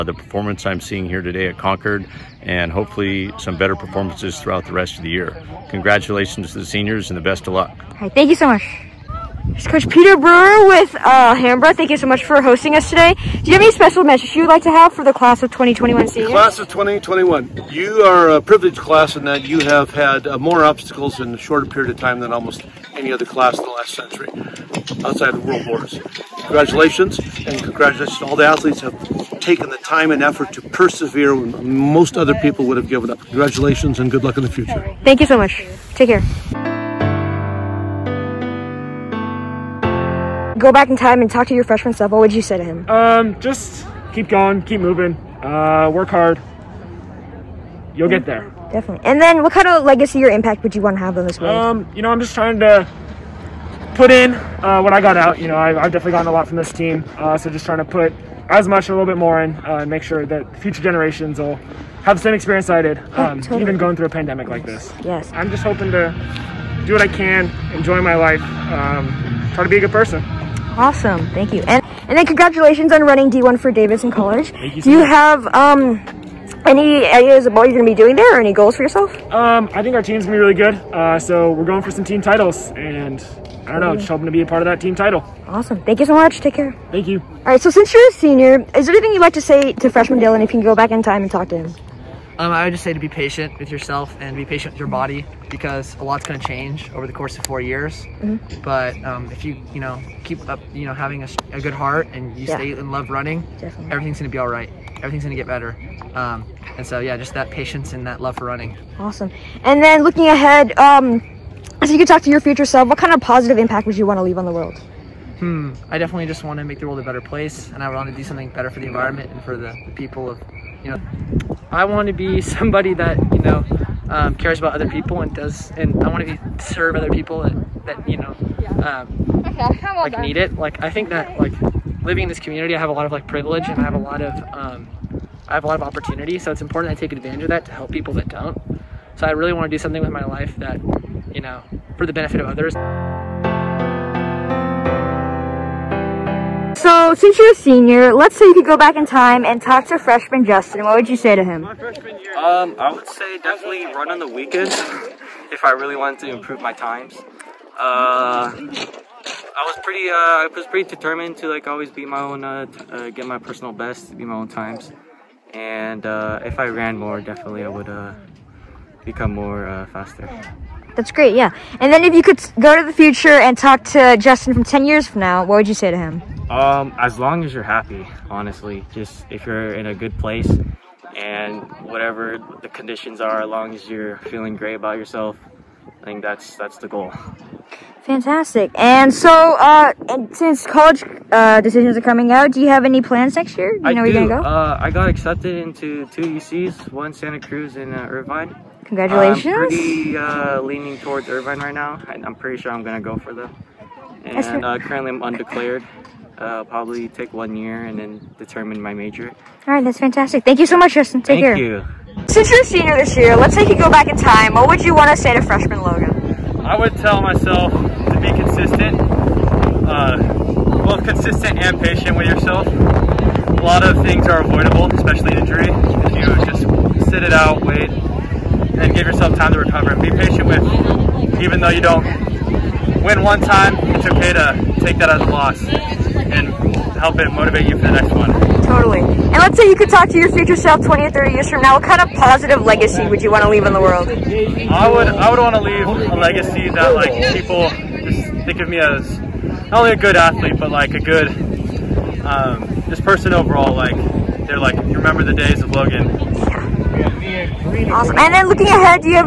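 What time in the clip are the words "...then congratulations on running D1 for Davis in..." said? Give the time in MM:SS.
01:12.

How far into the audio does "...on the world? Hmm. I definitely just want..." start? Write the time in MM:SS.
01:54.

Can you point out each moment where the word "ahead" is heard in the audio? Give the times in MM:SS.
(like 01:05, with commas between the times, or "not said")
01:50, 04:18.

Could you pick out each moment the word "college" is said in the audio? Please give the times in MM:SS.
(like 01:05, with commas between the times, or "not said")
01:14, 03:10.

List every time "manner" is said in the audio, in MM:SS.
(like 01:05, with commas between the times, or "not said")
not said.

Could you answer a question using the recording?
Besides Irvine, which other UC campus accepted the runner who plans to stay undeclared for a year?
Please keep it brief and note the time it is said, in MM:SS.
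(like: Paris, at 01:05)
Santa Cruz, at 03:17.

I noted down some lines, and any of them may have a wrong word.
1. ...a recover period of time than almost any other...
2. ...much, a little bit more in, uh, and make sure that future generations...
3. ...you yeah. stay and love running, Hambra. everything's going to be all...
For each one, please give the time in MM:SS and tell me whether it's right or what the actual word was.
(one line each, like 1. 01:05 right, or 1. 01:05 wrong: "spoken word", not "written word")
1. 00:21 wrong: "shorter", not "recover"
2. 00:58 right
3. 01:42 wrong: "Definitely", not "Hambra".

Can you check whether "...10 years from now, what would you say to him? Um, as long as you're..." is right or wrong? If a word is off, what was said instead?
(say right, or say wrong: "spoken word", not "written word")
right.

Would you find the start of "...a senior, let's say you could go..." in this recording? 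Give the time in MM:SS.
02:27.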